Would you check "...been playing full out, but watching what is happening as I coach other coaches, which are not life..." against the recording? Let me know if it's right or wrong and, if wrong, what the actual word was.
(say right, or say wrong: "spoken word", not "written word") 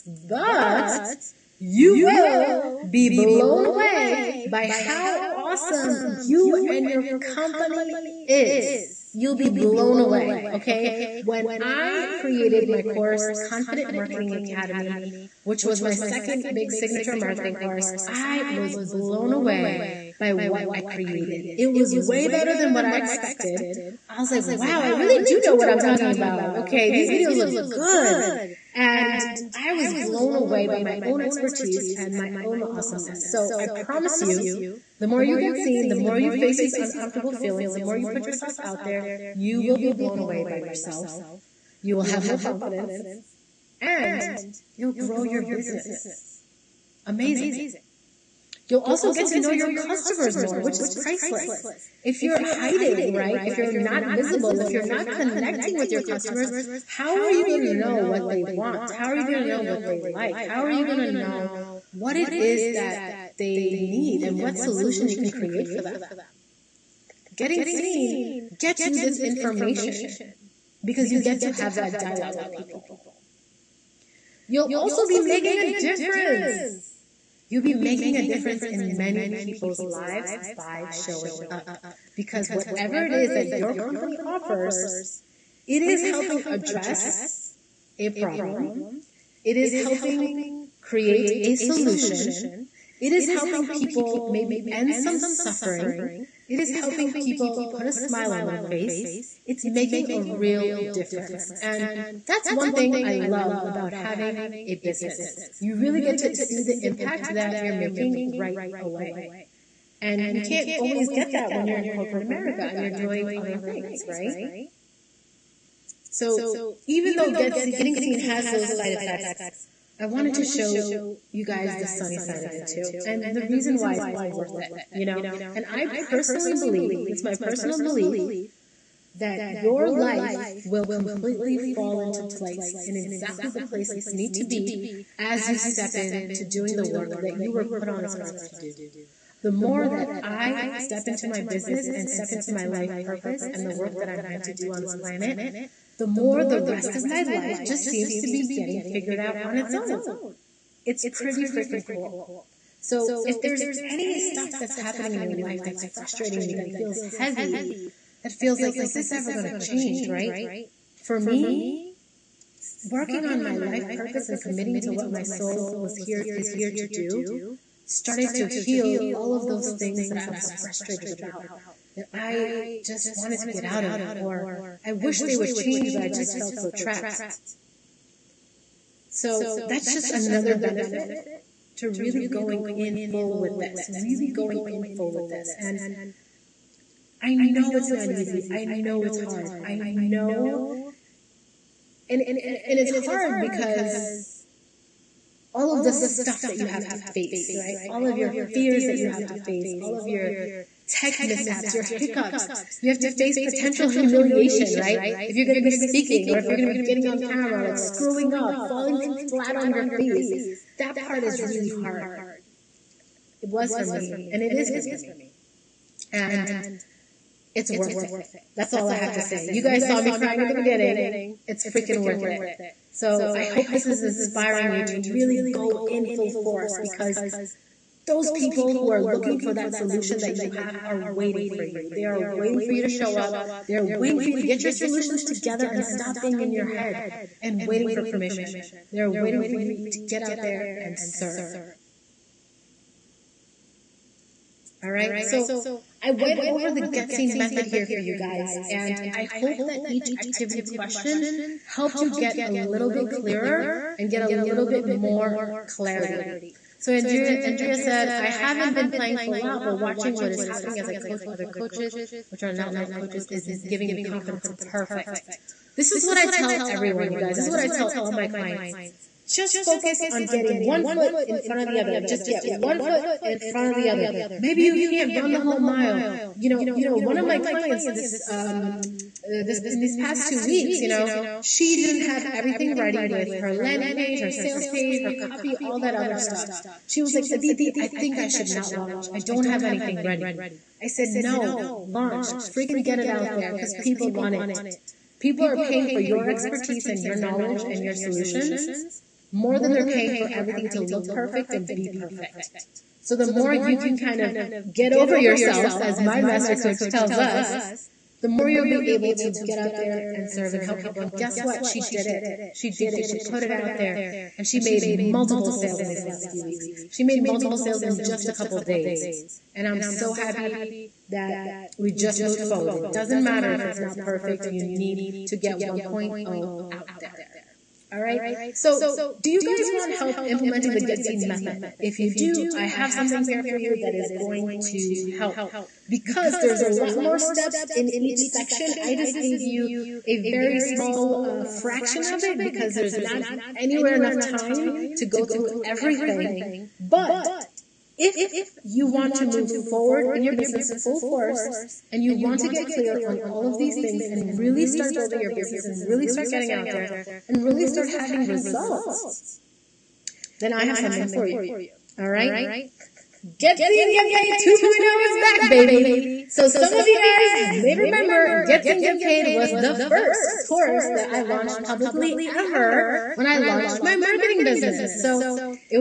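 right.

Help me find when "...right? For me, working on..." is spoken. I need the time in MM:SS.
02:40.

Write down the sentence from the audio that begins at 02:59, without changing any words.
So that's just another benefit to really going in full with this, really going in full with this.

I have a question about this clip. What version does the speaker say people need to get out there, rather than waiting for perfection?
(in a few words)
1.0.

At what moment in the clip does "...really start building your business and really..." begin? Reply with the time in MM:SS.
05:54.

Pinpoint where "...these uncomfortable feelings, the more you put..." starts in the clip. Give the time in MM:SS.
00:36.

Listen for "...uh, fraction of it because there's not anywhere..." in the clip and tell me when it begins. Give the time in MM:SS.
05:41.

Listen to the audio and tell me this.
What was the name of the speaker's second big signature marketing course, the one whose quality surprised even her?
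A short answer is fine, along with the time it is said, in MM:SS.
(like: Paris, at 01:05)
Confident Marketing Academy, at 00:13.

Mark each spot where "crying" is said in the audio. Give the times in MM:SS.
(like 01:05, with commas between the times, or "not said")
03:40.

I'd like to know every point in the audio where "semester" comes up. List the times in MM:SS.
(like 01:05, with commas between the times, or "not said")
not said.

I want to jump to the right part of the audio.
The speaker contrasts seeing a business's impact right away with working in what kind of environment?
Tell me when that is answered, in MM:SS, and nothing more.
01:51.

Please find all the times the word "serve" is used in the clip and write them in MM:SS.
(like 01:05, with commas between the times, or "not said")
04:00, 05:10.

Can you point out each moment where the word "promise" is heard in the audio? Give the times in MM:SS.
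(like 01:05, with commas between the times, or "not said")
00:33.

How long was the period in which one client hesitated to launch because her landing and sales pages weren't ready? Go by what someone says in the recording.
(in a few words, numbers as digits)
2 weeks.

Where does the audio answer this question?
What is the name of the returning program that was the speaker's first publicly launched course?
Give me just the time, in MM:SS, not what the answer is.
06:03.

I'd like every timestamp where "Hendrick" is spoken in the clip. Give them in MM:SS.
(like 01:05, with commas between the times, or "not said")
not said.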